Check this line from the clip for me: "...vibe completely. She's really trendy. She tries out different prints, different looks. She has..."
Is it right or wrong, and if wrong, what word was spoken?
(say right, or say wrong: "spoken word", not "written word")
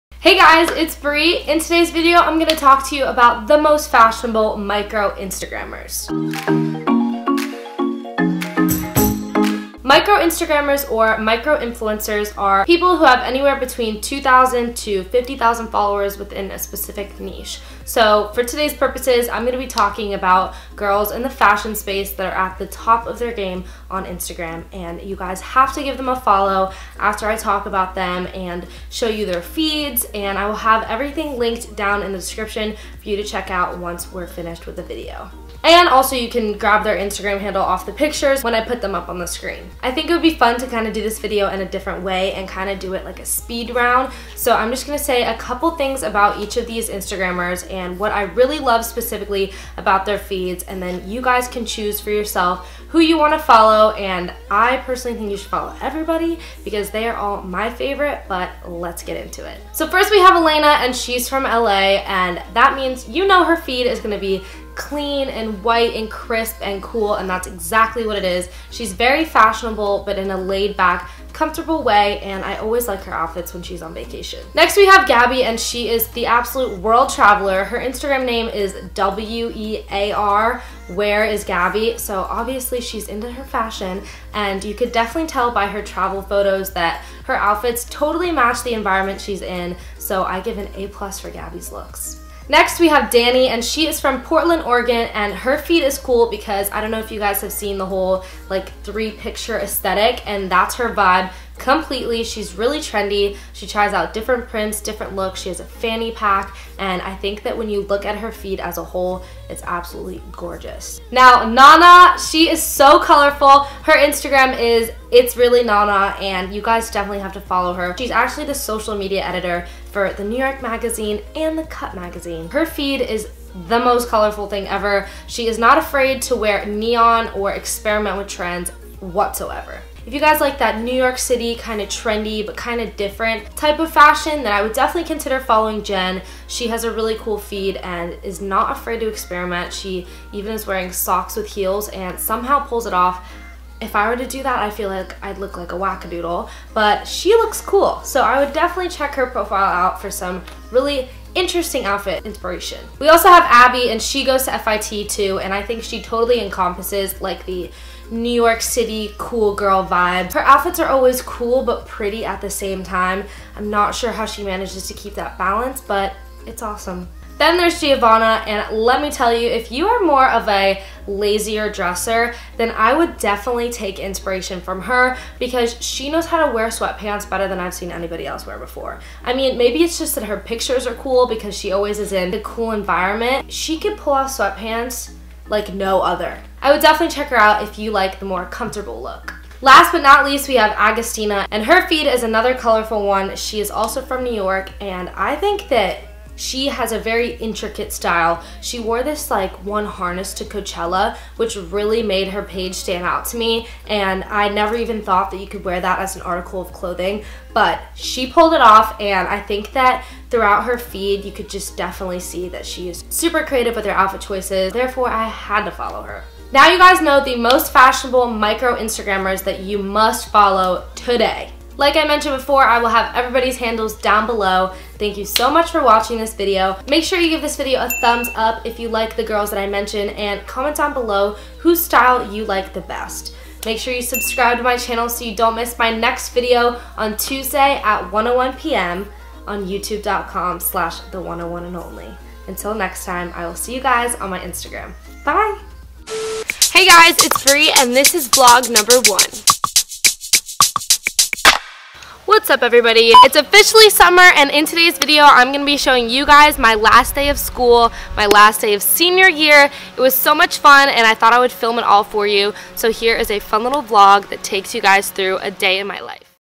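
right.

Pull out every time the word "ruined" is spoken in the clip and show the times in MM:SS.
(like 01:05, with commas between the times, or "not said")
not said.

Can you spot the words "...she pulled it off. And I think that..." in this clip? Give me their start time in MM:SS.
03:27.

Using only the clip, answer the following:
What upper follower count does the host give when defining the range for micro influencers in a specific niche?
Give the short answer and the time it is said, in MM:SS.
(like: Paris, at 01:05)
50,000, at 00:15.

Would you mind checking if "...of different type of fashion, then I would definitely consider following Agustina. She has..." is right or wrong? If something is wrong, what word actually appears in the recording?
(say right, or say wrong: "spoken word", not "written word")
wrong: "Jenn", not "Agustina".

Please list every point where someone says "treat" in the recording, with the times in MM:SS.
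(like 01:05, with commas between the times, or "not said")
not said.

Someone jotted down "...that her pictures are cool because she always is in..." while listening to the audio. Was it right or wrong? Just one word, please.
right.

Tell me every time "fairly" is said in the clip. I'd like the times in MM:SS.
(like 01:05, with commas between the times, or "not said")
not said.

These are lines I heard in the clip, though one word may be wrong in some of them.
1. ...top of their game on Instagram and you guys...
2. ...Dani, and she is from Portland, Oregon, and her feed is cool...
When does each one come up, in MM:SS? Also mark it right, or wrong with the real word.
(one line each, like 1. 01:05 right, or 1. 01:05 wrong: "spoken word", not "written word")
1. 00:22 right
2. 01:33 right.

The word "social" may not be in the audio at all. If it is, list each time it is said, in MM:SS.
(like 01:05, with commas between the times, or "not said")
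01:58.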